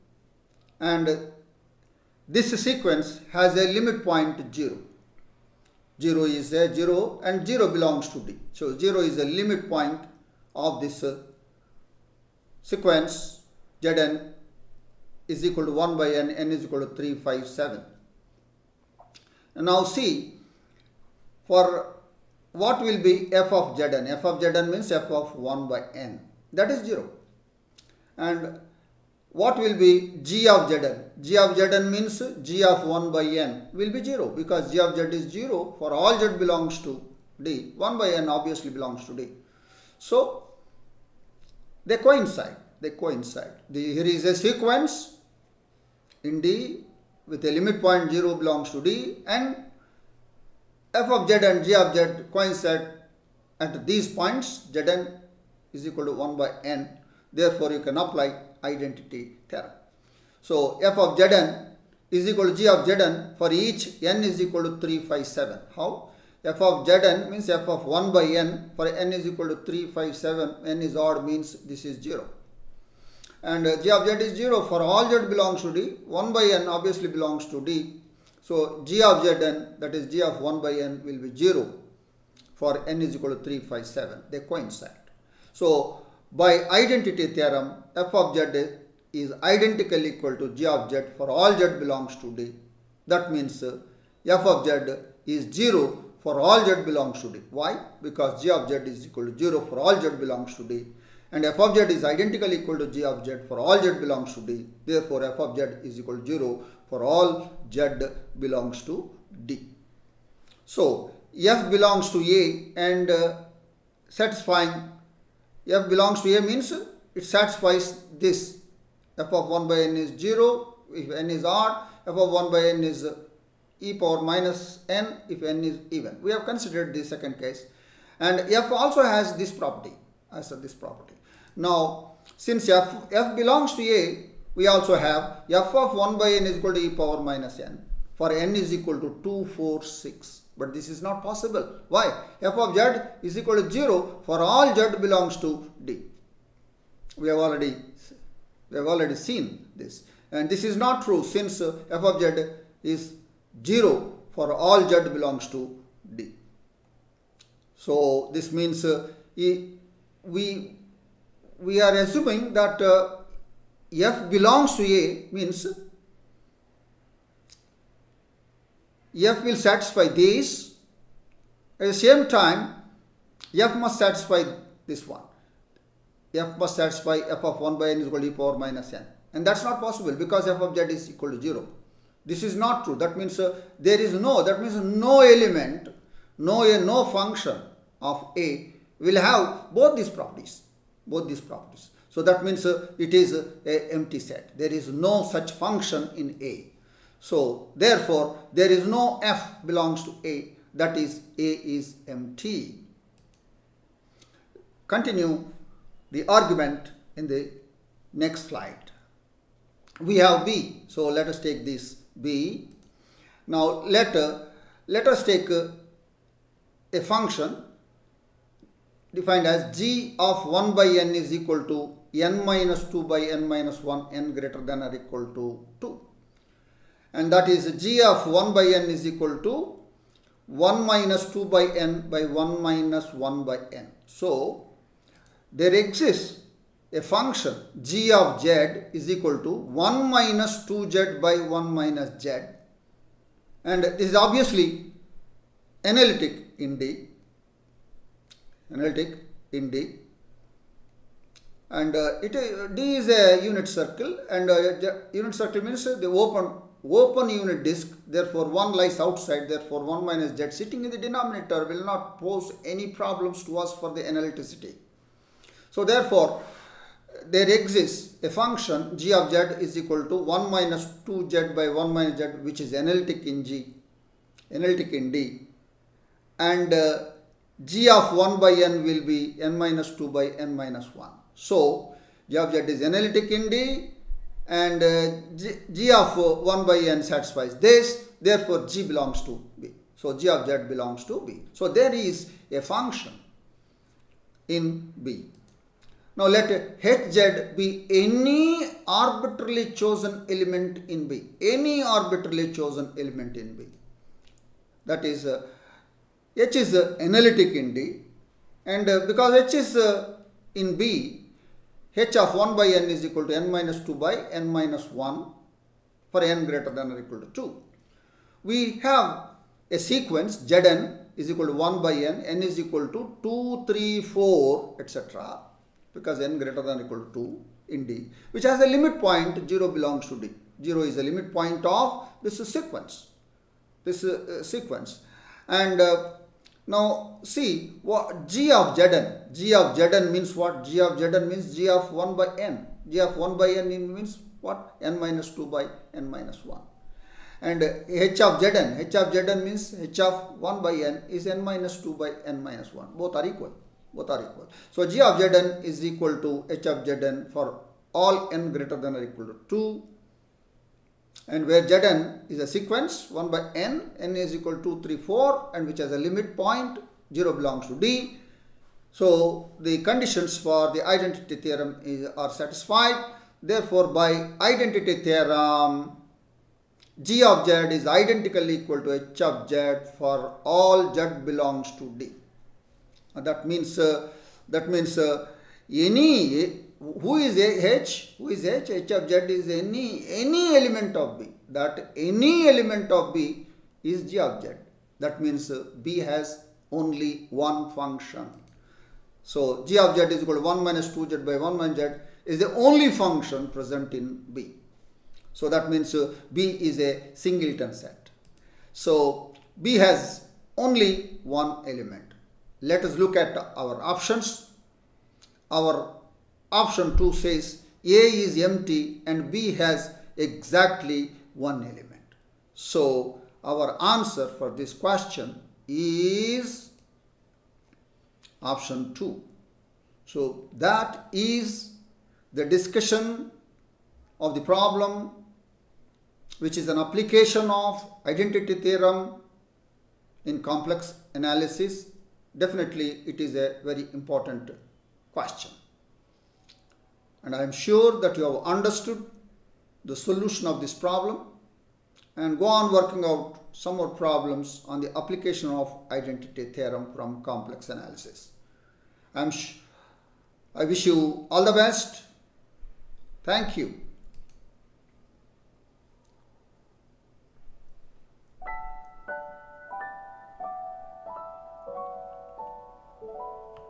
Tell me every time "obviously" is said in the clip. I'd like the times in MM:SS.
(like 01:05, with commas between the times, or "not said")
00:38, 01:16, 04:04.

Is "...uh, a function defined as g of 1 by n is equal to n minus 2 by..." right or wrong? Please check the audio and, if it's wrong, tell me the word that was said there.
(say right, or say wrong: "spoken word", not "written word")
right.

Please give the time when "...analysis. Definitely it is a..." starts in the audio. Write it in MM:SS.
07:21.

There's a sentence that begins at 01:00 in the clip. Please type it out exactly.
So f of zn is equal to g of zn for each n is equal to 3, 5, 7.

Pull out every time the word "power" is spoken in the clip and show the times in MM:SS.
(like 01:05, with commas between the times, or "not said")
02:04, 02:16, 02:58.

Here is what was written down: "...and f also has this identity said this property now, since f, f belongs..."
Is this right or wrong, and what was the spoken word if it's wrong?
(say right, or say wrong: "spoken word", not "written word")
wrong: "property", not "identity".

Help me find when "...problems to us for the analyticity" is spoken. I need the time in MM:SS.
04:22.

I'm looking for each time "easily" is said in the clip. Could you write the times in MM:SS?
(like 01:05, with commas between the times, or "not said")
not said.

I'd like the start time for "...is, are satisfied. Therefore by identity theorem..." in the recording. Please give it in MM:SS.
06:11.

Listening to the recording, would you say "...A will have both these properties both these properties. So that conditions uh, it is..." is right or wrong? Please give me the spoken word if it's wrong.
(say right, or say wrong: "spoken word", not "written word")
wrong: "means", not "conditions".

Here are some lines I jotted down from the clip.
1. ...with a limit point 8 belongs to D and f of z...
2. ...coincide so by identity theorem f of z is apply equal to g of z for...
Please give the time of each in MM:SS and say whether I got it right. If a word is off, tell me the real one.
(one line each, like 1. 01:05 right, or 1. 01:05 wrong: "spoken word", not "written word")
1. 00:47 wrong: "0", not "8"
2. 01:24 wrong: "identically", not "apply".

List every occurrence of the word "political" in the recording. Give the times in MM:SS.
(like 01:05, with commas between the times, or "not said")
not said.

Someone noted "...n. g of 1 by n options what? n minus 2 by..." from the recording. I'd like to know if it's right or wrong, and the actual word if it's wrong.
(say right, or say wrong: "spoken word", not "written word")
wrong: "means", not "options".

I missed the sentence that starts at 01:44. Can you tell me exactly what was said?
Therefore, f of z is equal to 0 for all z belongs to d.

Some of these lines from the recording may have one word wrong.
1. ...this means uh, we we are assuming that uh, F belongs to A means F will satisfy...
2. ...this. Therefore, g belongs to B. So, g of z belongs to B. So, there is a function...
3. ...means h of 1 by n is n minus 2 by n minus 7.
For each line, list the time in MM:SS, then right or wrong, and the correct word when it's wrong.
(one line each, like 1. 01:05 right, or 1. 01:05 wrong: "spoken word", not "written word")
1. 02:38 right
2. 04:47 right
3. 05:49 wrong: "1", not "7".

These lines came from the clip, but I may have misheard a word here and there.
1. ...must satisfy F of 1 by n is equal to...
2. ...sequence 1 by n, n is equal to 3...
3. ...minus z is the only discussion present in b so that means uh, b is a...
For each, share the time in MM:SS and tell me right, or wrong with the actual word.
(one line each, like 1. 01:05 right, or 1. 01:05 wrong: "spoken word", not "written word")
1. 02:56 right
2. 06:02 right
3. 06:41 wrong: "function", not "discussion".